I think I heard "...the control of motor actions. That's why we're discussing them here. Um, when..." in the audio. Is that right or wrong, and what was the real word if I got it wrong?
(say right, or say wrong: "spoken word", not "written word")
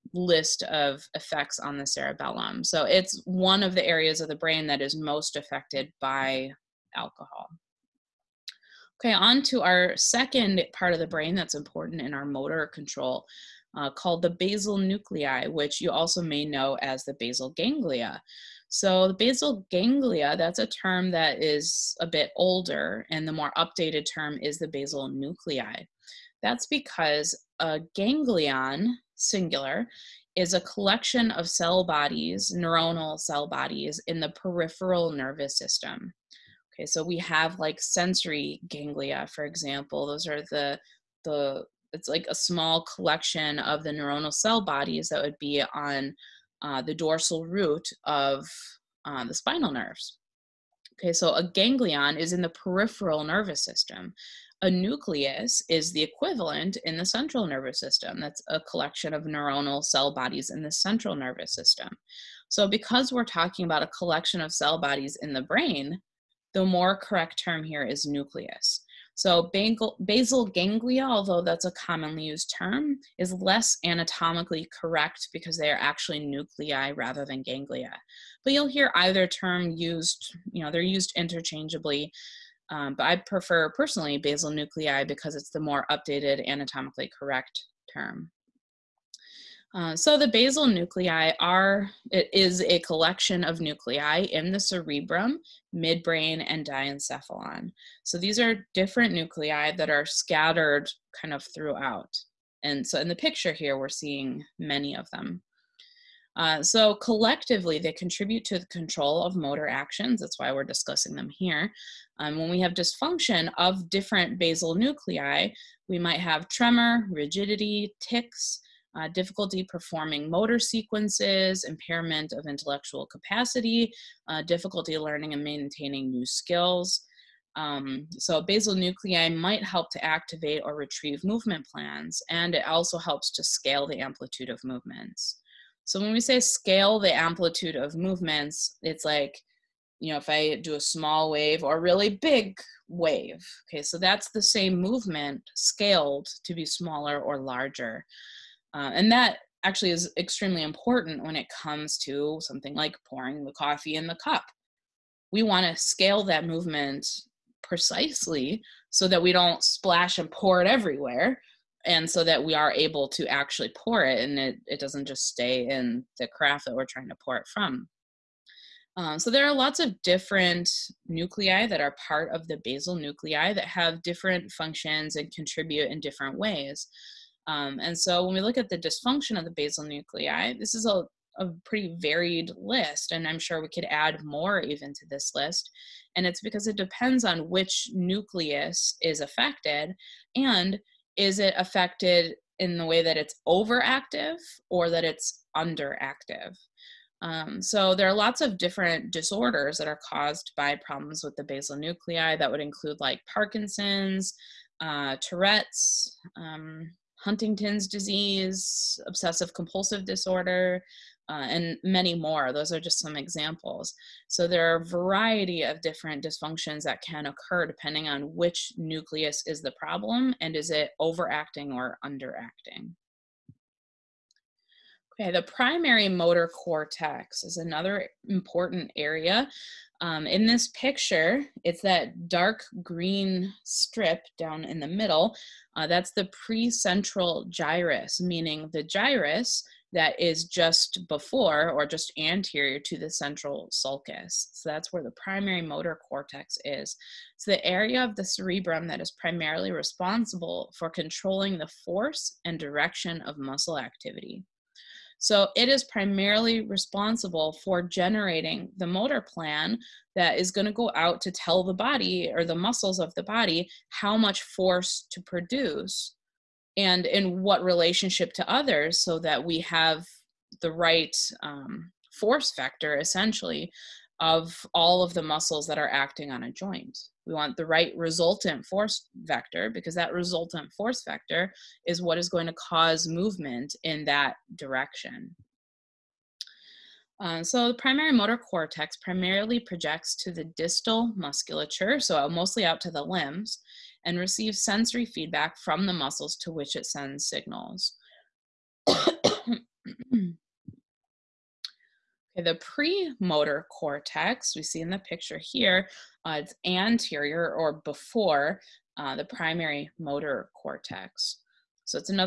right.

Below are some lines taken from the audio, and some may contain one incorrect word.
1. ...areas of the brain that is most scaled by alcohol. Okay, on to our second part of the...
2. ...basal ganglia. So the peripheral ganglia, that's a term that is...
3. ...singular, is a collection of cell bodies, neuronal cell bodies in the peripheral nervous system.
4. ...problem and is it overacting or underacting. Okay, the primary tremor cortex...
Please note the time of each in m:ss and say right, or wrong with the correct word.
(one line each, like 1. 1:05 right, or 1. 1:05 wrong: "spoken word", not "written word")
1. 0:03 wrong: "affected", not "scaled"
2. 0:17 wrong: "basal", not "peripheral"
3. 0:29 right
4. 3:39 wrong: "motor", not "tremor".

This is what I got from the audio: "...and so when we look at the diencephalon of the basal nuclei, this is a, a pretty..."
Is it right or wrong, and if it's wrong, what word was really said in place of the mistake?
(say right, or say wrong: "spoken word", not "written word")
wrong: "dysfunction", not "diencephalon".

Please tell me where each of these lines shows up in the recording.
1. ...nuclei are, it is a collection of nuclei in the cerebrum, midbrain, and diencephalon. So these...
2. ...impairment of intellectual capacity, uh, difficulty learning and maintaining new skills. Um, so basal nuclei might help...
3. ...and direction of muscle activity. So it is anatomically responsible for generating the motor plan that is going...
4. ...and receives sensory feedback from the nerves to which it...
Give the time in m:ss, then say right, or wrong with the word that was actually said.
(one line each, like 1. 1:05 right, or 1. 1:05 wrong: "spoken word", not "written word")
1. 1:30 right
2. 2:01 right
3. 4:12 wrong: "primarily", not "anatomically"
4. 4:54 wrong: "muscles", not "nerves".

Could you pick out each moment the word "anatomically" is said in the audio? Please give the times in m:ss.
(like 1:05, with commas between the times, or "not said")
1:13, 1:26.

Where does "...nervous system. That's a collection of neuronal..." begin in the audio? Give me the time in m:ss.
0:57.